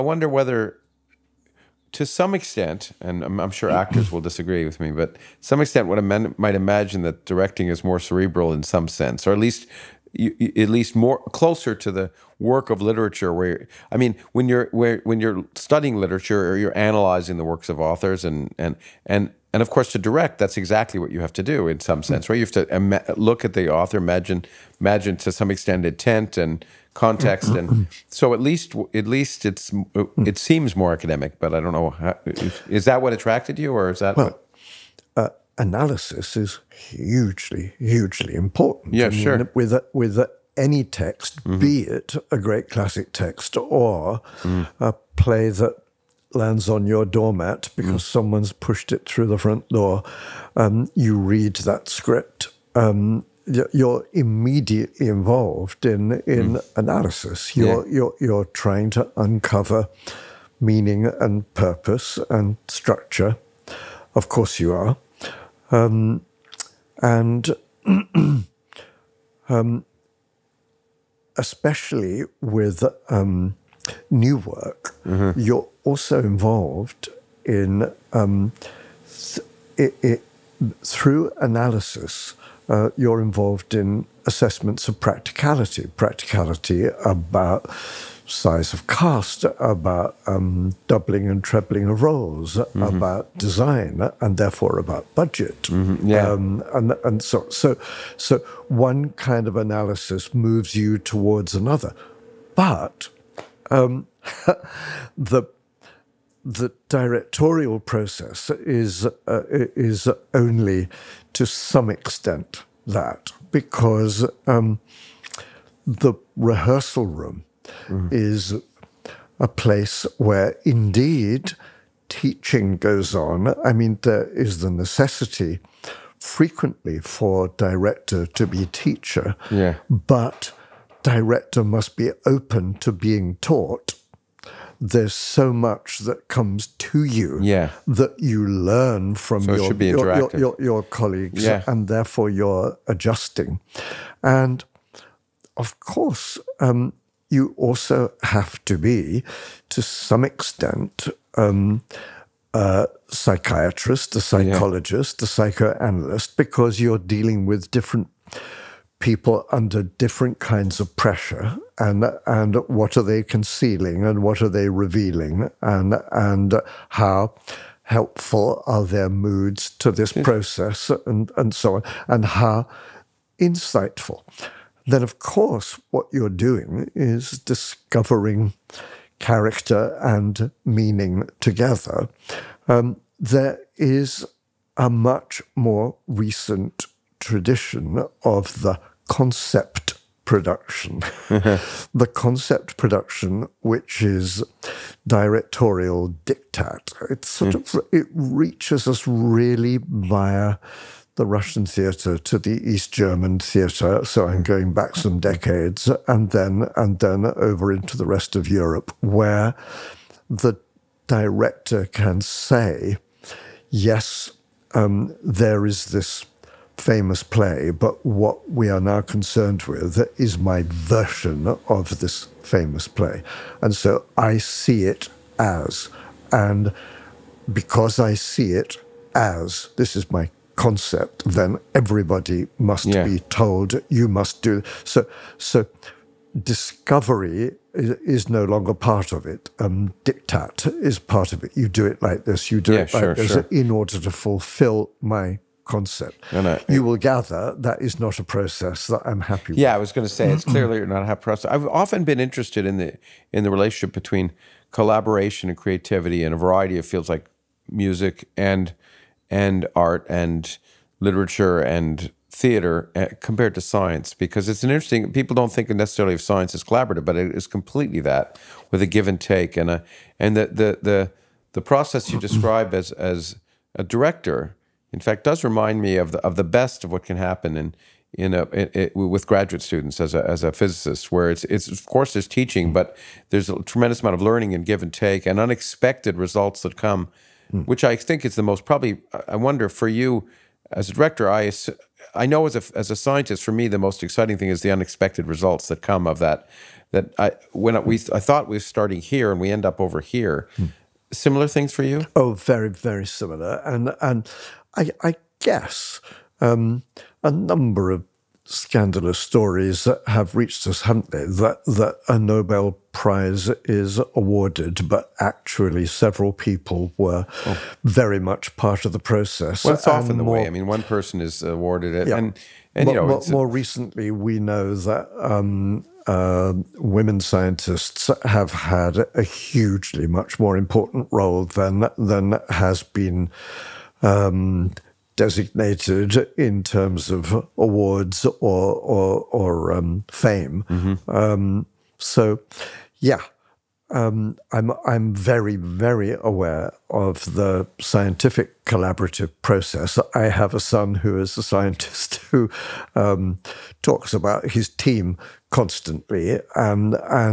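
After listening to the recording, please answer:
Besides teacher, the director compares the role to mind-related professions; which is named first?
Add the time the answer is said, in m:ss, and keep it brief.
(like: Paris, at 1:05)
Psychiatrist, at 2:32.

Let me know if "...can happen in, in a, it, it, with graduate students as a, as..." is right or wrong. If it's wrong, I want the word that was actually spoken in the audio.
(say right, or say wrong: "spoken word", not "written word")
right.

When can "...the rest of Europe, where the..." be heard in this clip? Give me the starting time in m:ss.
3:27.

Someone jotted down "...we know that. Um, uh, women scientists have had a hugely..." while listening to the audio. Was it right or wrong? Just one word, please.
right.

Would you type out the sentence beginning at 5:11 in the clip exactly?
That that a Nobel Prize is awarded, but actually several people were oh.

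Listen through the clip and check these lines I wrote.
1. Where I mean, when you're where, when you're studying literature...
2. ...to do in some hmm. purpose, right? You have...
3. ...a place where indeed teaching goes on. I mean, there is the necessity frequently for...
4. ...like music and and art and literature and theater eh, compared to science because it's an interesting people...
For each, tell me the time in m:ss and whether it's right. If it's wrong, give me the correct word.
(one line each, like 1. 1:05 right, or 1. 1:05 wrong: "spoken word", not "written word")
1. 0:13 right
2. 0:21 wrong: "sense", not "purpose"
3. 1:59 right
4. 4:17 right.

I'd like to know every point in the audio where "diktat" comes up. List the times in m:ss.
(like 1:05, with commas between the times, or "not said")
3:16, 4:00.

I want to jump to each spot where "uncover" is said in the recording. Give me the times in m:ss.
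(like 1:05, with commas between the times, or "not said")
0:59.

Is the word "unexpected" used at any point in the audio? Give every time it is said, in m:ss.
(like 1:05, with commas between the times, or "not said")
4:45, 4:54.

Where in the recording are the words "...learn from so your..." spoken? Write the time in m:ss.
2:18.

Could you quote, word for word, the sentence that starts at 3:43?
And so I see it as, and because I see it as, this is my concept, then everybody must yeah.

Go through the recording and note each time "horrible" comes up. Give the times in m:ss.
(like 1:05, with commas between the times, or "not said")
not said.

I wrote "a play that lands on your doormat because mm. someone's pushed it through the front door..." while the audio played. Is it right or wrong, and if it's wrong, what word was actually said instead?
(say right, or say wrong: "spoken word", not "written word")
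right.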